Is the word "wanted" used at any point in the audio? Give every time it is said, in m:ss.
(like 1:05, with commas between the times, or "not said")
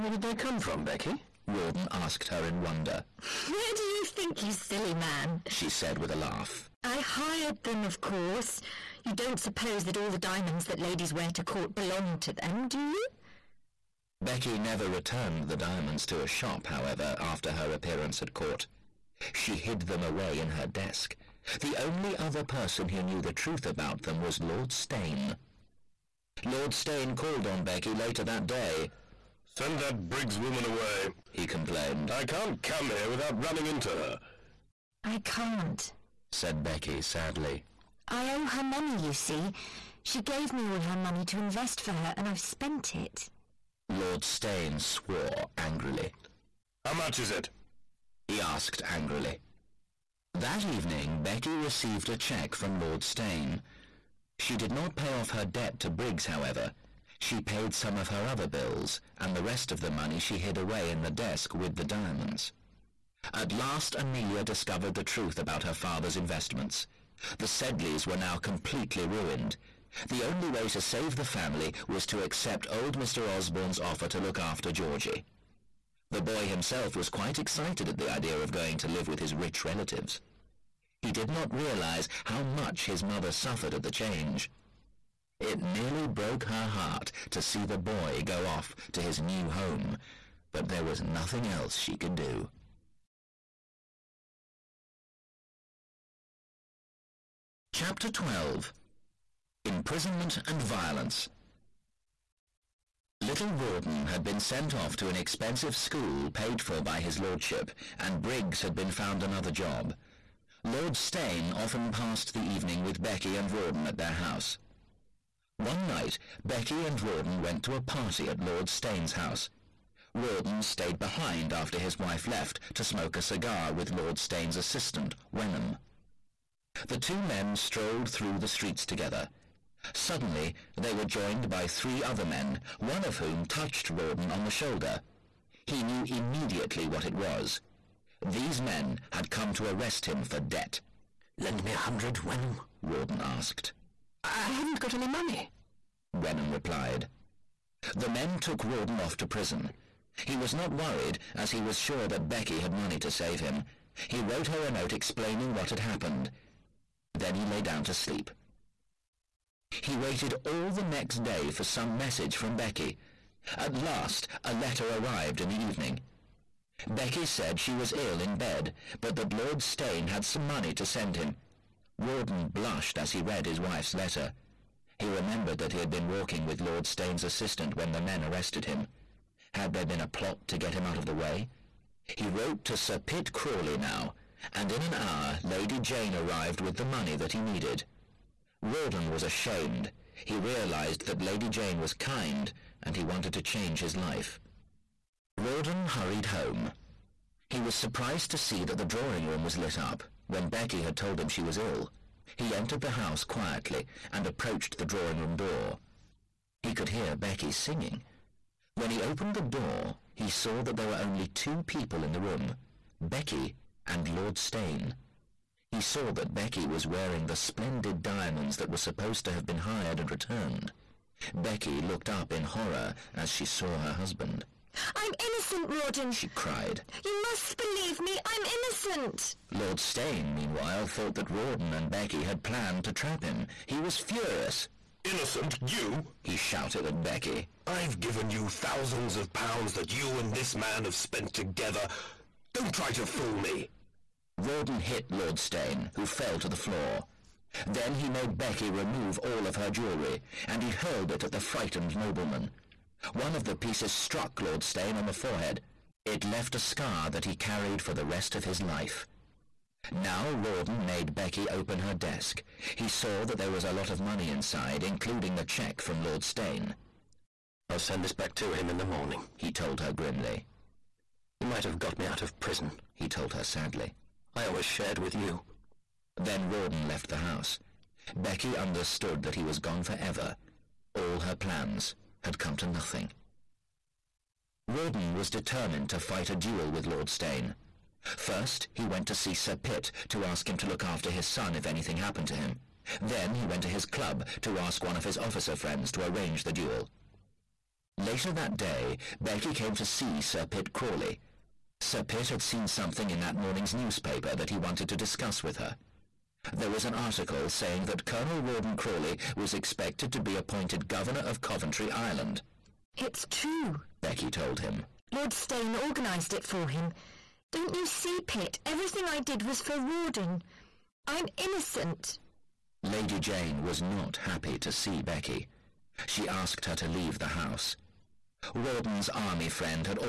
3:13, 5:04.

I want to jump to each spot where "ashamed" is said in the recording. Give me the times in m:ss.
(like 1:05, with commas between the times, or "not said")
3:09.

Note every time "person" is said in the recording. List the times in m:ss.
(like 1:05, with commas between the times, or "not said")
0:22.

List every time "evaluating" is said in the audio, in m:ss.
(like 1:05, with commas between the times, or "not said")
not said.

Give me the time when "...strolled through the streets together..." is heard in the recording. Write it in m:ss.
2:07.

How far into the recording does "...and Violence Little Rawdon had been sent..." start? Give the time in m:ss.
1:40.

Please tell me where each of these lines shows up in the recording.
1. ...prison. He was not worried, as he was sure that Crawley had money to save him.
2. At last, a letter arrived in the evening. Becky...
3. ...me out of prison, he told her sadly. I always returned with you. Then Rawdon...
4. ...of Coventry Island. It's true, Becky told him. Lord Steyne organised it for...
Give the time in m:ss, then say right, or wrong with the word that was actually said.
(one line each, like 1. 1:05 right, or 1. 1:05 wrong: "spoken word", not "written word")
1. 2:29 wrong: "Becky", not "Crawley"
2. 2:43 right
3. 4:31 wrong: "shared", not "returned"
4. 5:11 right.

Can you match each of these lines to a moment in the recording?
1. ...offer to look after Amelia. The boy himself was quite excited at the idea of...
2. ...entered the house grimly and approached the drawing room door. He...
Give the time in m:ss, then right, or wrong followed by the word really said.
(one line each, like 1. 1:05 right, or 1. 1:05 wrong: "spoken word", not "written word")
1. 1:13 wrong: "Georgie", not "Amelia"
2. 3:22 wrong: "quietly", not "grimly".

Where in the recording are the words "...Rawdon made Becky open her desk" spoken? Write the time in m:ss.
4:20.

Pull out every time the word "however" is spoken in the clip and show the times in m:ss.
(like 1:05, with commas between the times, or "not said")
0:16, 0:56.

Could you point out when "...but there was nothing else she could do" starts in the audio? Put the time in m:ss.
1:30.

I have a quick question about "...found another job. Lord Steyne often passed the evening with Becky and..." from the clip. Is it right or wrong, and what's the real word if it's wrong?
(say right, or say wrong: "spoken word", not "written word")
right.